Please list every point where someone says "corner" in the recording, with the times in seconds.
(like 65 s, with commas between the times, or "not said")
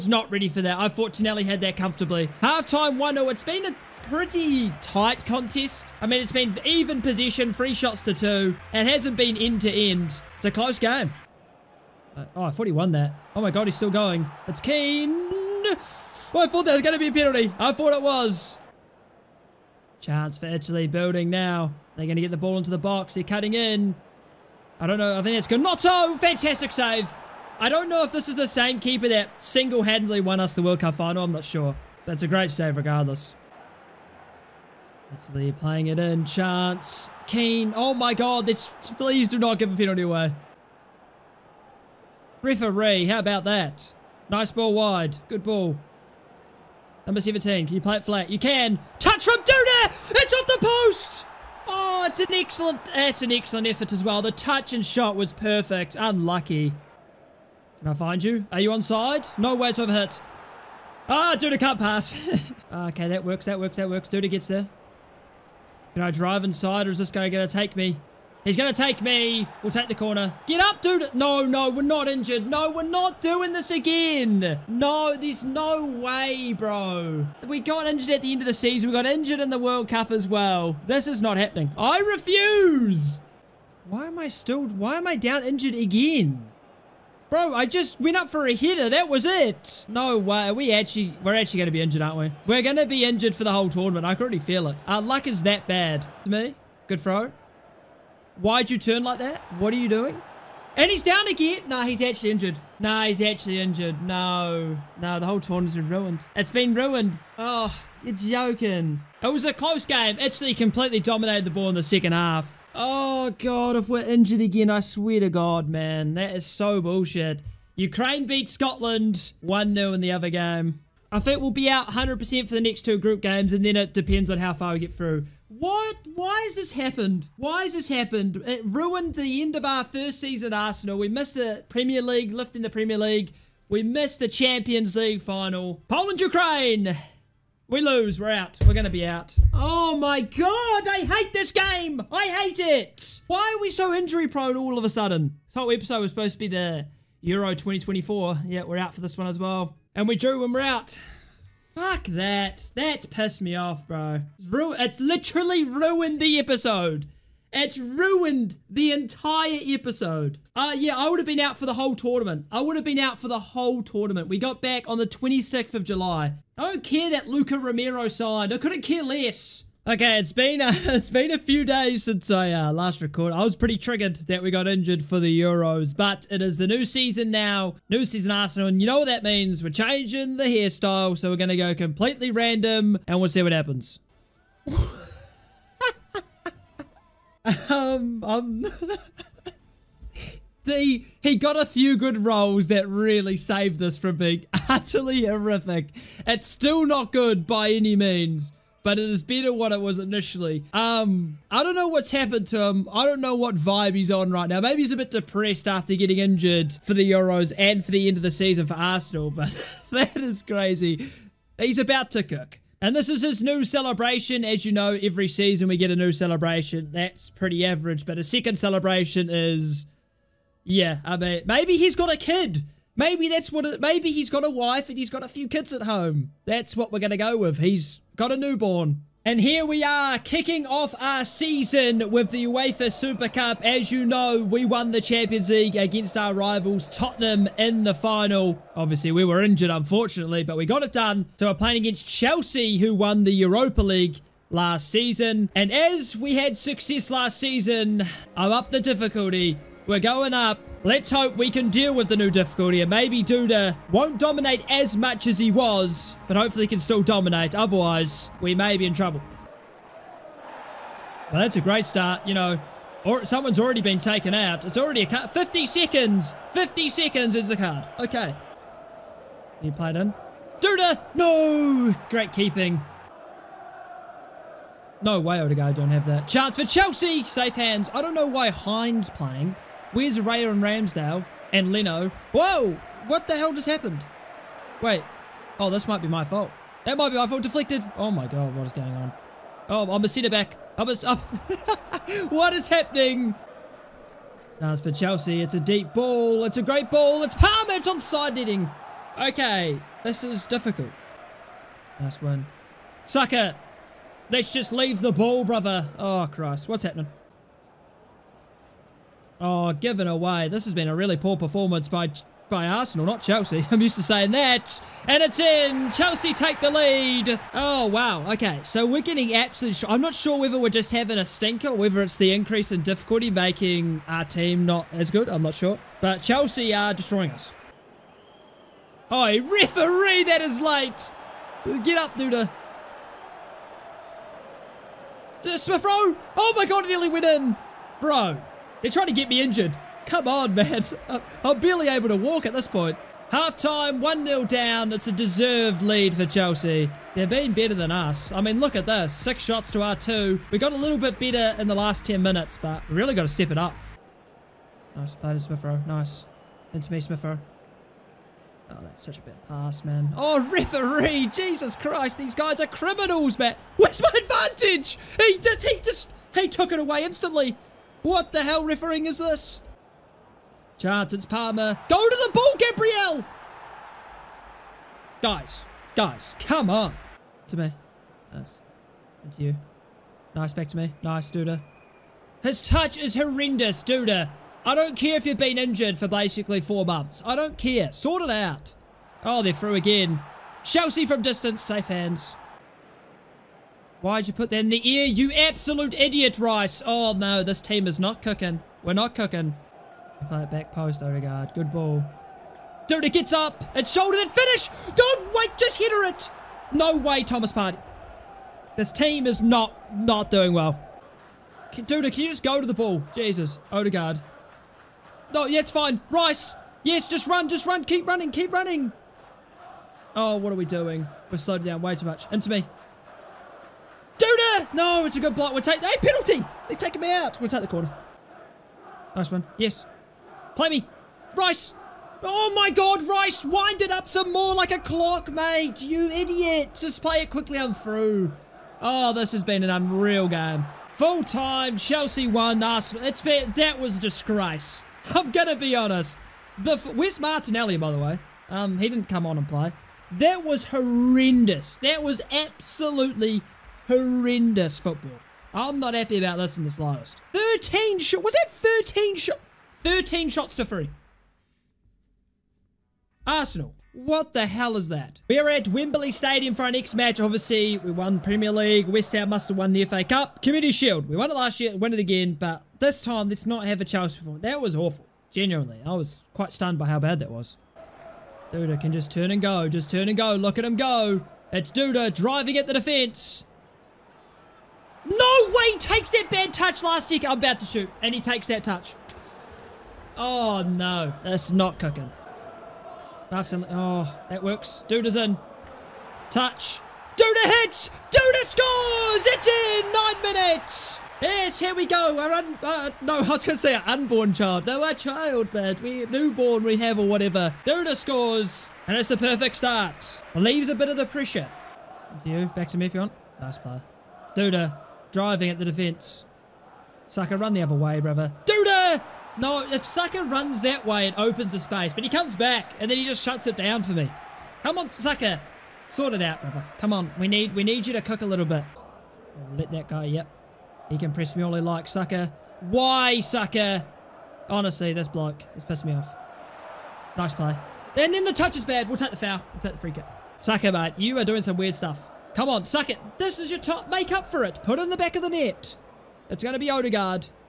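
69 s, 427 s.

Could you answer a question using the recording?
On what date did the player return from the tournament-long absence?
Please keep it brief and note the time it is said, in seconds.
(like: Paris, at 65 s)
26th of July, at 165 s.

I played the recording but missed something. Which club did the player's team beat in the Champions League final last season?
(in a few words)
Tottenham.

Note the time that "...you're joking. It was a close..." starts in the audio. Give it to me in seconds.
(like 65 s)
108 s.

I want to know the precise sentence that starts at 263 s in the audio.
Or someone's already been taken out.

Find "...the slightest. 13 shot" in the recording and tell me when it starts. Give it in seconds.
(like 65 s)
456 s.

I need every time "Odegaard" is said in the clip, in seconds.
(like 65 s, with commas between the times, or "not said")
275 s, 401 s, 413 s, 546 s.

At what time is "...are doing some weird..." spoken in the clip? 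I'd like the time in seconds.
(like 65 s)
541 s.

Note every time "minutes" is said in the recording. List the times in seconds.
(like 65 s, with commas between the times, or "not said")
352 s, 500 s.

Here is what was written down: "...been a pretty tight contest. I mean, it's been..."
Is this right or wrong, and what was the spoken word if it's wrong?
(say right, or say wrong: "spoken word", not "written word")
right.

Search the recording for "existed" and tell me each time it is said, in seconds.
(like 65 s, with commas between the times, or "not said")
not said.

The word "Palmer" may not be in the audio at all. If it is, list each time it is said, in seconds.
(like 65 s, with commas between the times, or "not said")
297 s, 371 s.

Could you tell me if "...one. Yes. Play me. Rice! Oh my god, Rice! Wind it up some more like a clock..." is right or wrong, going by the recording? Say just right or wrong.
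right.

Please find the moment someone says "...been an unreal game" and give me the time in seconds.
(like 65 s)
439 s.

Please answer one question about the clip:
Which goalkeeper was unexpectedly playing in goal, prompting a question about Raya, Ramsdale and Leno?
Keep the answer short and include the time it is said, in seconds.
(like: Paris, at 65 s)
Hein, at 278 s.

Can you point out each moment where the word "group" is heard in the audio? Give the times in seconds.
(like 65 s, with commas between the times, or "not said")
122 s.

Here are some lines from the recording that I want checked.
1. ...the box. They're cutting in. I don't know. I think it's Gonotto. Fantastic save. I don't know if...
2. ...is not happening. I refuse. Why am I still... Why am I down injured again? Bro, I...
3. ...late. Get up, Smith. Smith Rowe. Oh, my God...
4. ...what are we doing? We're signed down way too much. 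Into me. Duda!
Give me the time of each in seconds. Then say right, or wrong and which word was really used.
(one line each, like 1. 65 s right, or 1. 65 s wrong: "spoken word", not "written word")
1. 22 s right
2. 81 s right
3. 330 s wrong: "Duda", not "Smith"
4. 420 s wrong: "slowed", not "signed".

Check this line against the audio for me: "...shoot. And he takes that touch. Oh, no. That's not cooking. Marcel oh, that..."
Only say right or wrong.
right.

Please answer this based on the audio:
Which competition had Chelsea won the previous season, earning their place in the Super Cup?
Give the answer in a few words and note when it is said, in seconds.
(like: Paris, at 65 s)
Europa League, at 243 s.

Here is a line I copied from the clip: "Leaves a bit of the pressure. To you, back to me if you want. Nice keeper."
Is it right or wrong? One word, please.
wrong.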